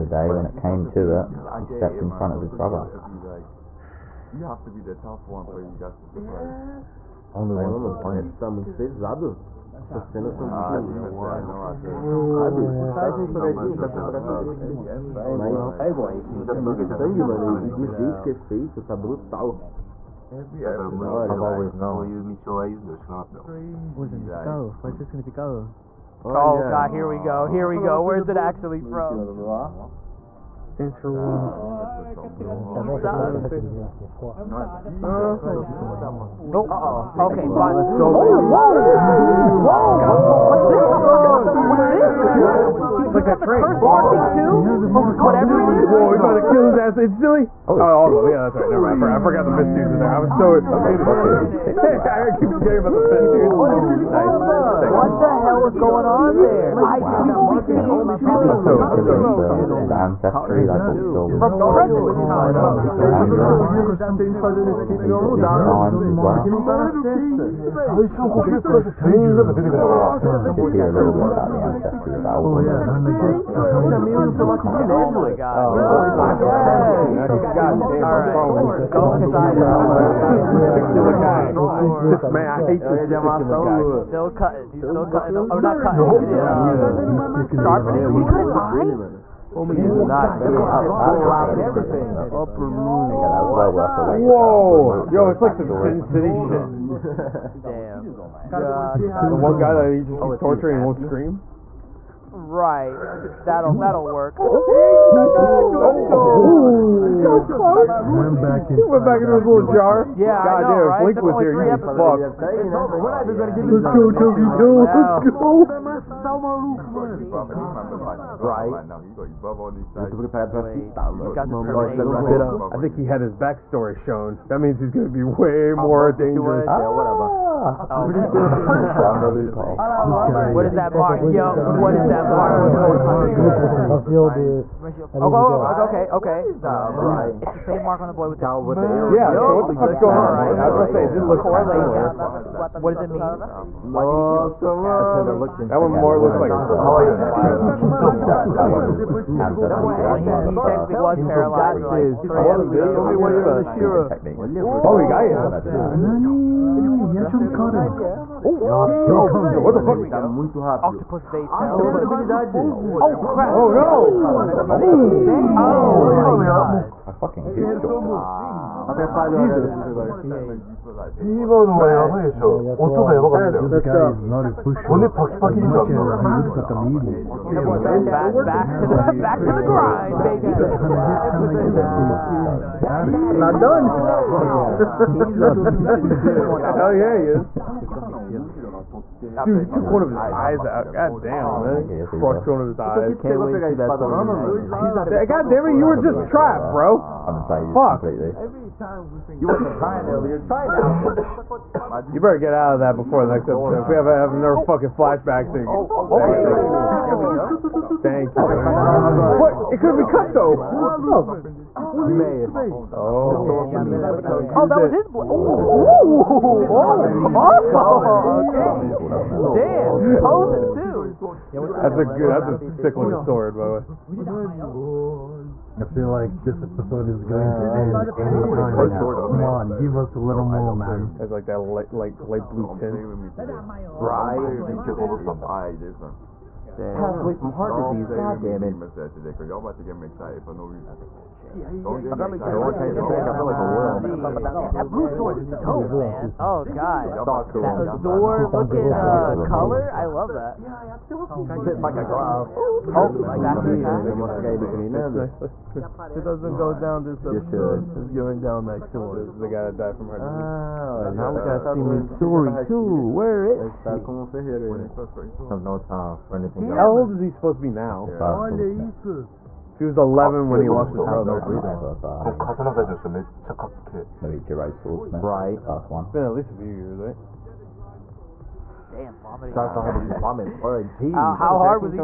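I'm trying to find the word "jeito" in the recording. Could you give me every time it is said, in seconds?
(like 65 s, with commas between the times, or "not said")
17 s.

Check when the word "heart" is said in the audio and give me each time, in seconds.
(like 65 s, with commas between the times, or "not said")
237 s, 260 s.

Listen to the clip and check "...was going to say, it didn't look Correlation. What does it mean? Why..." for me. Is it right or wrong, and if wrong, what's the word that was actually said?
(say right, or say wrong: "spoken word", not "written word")
right.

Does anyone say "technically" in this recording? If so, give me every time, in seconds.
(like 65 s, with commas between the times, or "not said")
150 s.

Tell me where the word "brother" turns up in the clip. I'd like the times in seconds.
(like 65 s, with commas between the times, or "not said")
2 s, 271 s.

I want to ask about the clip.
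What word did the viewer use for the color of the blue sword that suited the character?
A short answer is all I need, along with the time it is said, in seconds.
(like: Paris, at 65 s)
azure, at 247 s.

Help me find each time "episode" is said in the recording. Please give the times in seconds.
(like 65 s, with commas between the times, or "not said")
111 s, 203 s, 226 s, 257 s.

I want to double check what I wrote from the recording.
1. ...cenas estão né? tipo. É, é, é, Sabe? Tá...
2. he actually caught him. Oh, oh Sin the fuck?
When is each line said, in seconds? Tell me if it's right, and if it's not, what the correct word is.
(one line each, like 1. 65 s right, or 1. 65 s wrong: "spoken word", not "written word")
1. 10 s right
2. 157 s wrong: "What", not "Sin".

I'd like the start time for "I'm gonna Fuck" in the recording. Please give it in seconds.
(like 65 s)
196 s.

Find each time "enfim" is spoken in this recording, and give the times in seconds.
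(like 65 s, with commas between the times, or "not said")
16 s.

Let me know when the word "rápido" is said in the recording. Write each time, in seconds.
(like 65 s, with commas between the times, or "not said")
160 s.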